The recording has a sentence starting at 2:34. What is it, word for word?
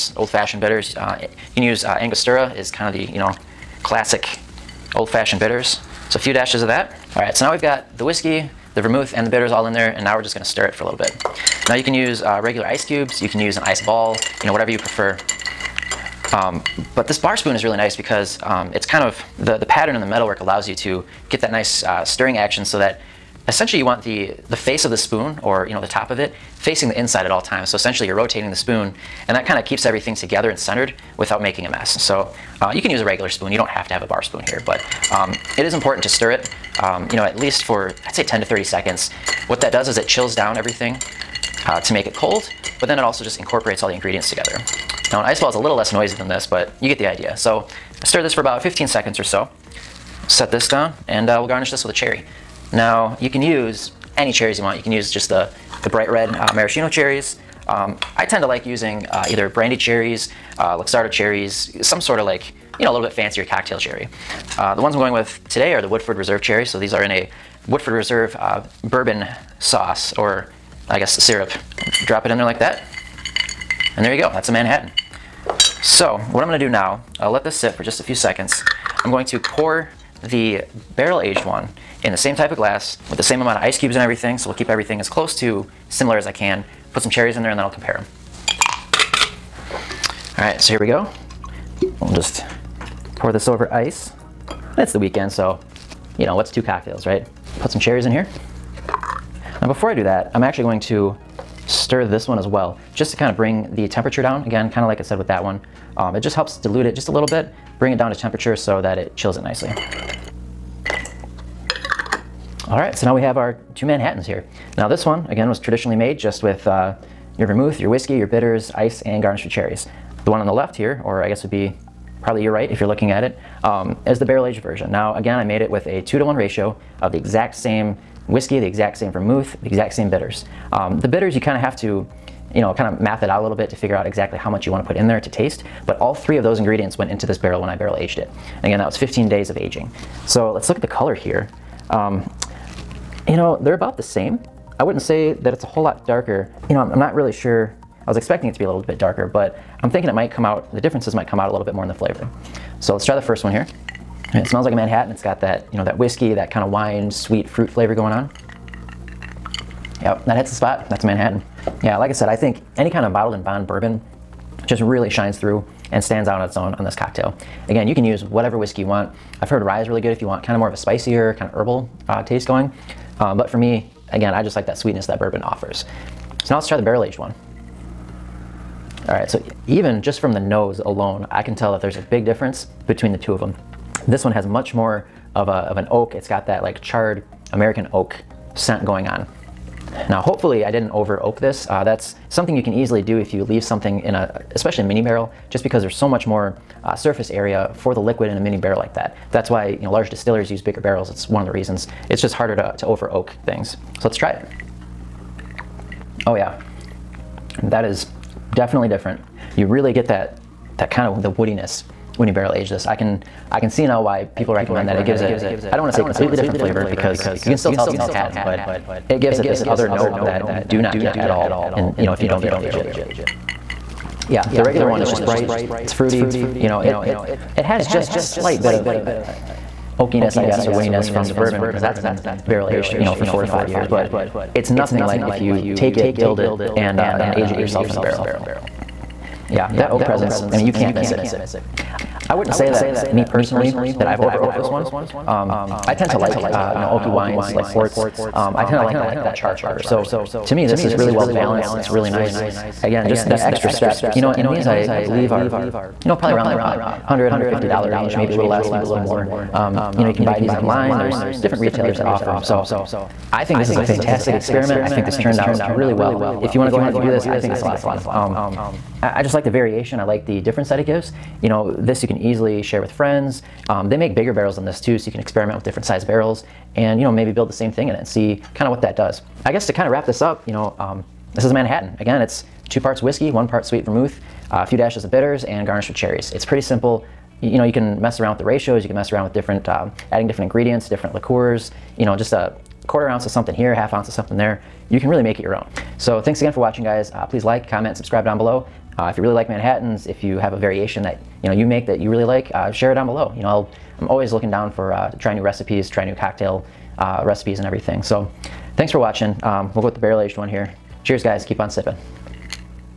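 And it smells like a Manhattan.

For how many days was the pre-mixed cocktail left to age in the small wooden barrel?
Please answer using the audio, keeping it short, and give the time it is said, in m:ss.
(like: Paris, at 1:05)
15 days, at 2:18.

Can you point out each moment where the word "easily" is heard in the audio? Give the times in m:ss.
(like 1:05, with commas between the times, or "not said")
3:12, 4:32.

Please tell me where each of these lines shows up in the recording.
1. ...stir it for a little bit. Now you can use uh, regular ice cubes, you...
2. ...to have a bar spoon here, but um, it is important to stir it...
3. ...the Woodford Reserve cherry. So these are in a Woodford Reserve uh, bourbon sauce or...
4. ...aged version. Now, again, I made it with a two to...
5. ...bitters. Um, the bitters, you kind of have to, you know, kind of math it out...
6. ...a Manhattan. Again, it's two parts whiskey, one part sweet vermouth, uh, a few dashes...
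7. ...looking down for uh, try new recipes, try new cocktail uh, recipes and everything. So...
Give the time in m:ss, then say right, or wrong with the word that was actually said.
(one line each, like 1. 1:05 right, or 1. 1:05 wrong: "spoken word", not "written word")
1. 0:10 right
2. 0:33 right
3. 1:05 right
4. 2:04 right
5. 2:10 right
6. 4:41 right
7. 5:04 right.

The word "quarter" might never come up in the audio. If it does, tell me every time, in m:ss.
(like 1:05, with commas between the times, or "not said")
4:52.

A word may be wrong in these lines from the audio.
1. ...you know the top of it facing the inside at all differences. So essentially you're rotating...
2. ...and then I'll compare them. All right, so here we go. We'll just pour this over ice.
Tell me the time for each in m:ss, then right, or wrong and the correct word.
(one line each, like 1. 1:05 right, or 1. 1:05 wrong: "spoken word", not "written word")
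1. 0:25 wrong: "times", not "differences"
2. 1:27 right.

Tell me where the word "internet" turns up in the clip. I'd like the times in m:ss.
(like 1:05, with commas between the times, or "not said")
not said.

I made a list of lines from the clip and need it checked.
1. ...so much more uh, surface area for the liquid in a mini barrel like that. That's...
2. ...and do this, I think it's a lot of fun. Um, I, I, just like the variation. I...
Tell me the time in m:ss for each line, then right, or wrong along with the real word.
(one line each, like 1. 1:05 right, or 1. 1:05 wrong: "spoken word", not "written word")
1. 3:15 right
2. 4:26 right.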